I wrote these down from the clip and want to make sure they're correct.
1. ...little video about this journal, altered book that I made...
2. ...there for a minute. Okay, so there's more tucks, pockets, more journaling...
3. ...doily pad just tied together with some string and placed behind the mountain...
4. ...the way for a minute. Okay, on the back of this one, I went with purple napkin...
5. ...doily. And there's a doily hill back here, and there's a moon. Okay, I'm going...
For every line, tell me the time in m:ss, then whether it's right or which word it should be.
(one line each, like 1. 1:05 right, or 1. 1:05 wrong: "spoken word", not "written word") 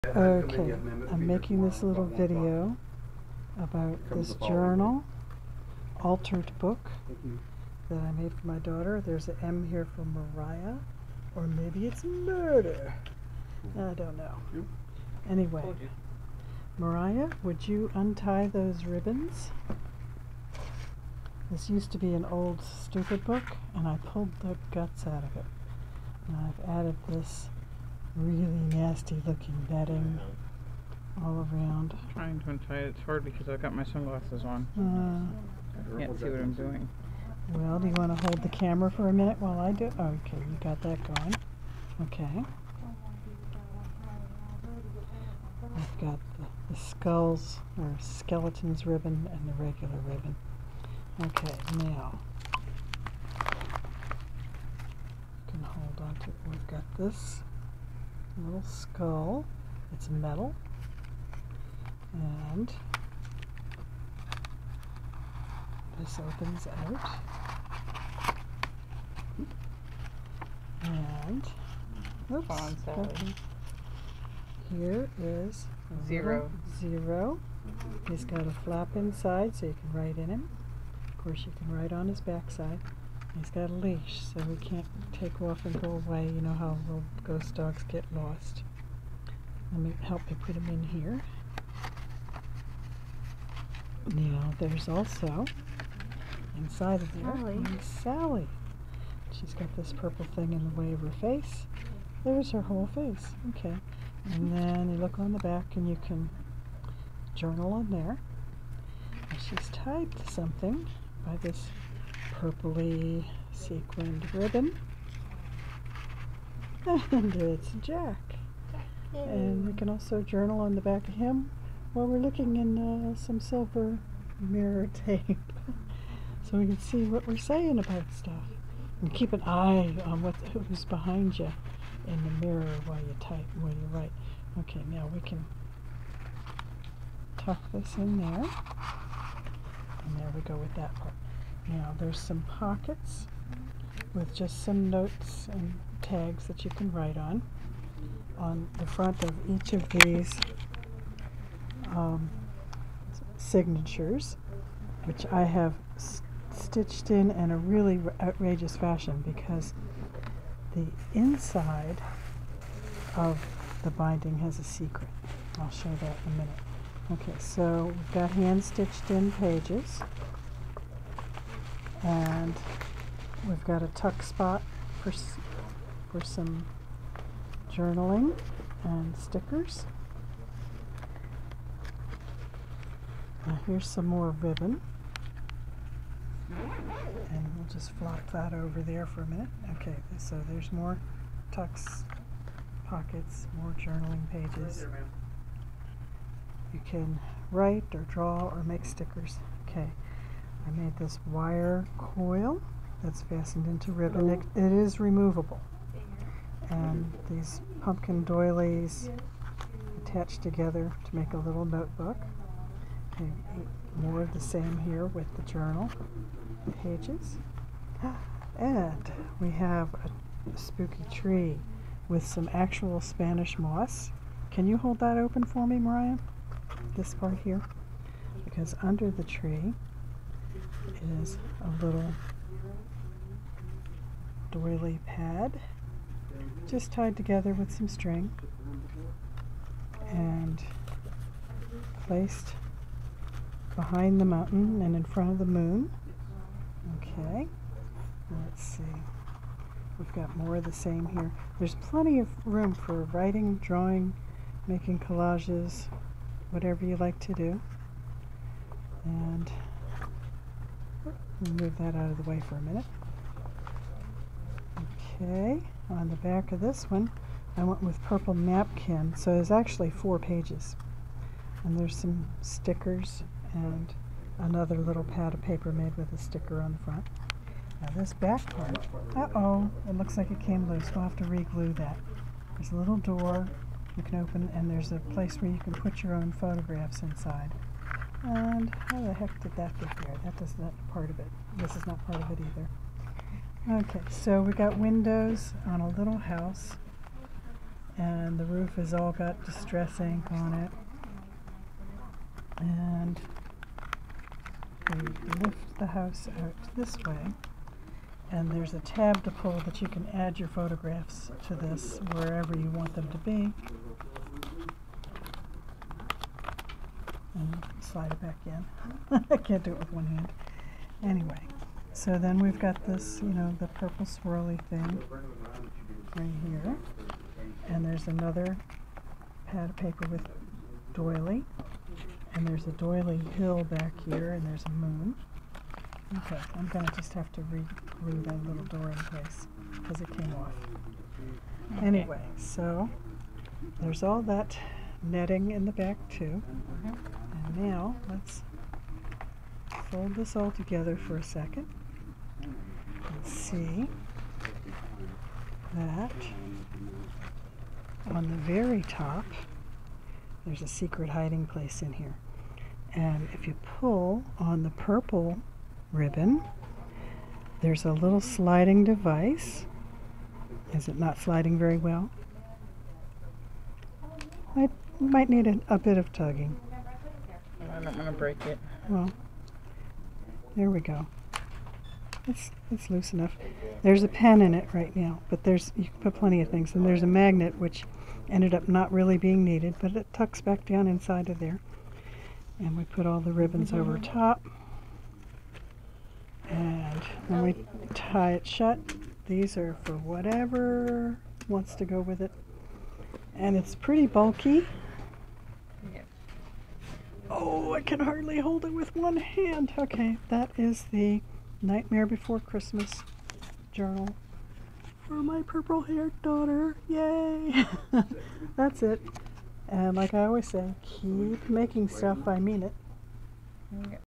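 1. 0:01 right
2. 3:08 right
3. 3:54 right
4. 4:22 right
5. 5:30 right.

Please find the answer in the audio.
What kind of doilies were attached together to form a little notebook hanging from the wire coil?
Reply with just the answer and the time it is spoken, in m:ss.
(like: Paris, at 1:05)
Pumpkin doilies, at 3:27.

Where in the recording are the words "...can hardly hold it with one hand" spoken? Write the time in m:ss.
6:47.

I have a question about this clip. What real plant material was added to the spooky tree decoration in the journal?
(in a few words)
Spanish moss.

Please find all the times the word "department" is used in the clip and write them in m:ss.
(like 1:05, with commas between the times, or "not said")
not said.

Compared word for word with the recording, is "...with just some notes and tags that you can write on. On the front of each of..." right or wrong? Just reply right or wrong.
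right.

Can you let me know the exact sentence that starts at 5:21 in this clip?
Anyway, so then we've got this, you know, the purple swirly thing right here.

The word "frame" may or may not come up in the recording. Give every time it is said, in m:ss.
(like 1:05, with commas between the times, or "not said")
not said.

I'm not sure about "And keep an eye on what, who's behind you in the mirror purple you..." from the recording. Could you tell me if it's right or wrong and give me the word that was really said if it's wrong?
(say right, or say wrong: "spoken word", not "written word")
wrong: "while", not "purple".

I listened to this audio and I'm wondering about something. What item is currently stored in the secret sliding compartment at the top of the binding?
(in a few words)
A pen.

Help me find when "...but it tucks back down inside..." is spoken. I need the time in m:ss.
6:29.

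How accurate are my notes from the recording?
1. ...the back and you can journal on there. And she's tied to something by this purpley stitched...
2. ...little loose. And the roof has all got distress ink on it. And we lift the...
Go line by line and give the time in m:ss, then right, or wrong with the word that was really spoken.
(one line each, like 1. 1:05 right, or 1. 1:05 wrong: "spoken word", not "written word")
1. 1:45 wrong: "sequined", not "stitched"
2. 4:55 wrong: "house", not "loose".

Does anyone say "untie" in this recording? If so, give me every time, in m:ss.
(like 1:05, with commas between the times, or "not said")
0:17, 0:32.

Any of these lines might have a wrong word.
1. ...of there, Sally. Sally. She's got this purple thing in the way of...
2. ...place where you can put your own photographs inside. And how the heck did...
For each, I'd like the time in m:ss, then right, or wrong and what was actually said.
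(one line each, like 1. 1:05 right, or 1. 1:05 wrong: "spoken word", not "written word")
1. 1:37 right
2. 4:45 right.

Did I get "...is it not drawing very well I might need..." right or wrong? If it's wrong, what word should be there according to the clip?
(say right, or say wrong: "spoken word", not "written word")
wrong: "sliding", not "drawing".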